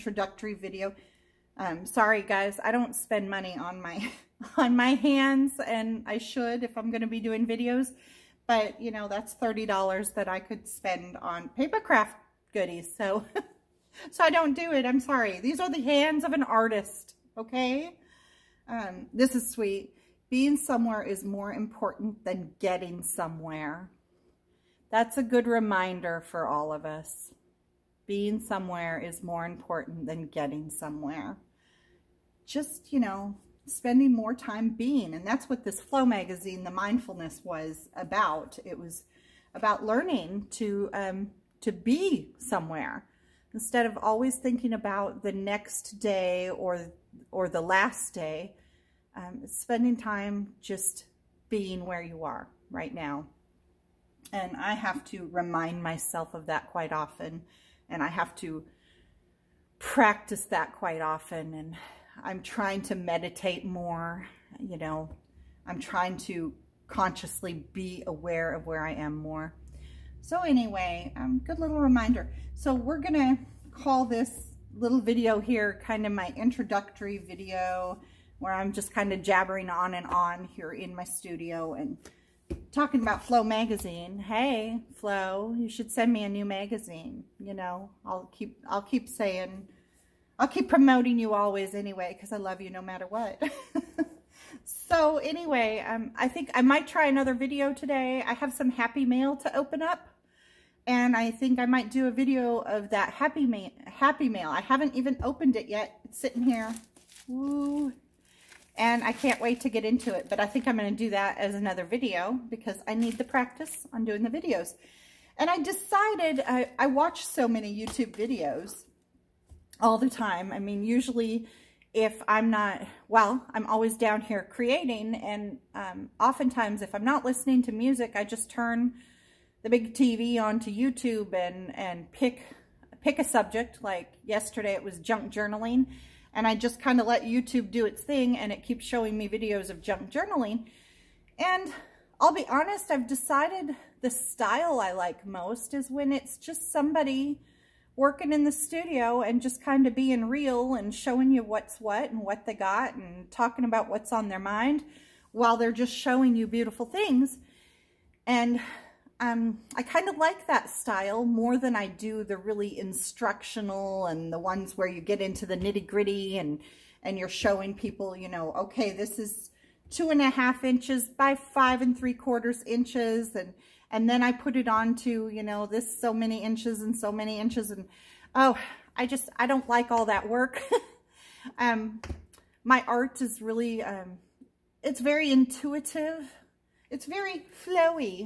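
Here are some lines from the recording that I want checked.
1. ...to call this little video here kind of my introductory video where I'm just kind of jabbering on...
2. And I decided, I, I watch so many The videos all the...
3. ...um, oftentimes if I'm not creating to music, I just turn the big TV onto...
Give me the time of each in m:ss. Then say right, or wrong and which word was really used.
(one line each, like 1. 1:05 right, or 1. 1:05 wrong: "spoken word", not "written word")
1. 1:13 right
2. 1:55 wrong: "YouTube", not "The"
3. 2:05 wrong: "listening", not "creating".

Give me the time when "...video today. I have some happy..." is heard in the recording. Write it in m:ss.
1:37.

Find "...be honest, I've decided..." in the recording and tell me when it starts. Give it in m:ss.
2:22.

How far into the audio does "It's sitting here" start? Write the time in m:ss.
1:46.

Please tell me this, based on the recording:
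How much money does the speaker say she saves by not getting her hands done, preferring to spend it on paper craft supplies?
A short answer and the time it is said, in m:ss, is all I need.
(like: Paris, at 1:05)
$30, at 0:09.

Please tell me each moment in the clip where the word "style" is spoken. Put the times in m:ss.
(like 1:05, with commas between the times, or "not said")
2:24, 2:40.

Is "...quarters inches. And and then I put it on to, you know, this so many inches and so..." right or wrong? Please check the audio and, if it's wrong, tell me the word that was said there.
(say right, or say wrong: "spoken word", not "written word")
right.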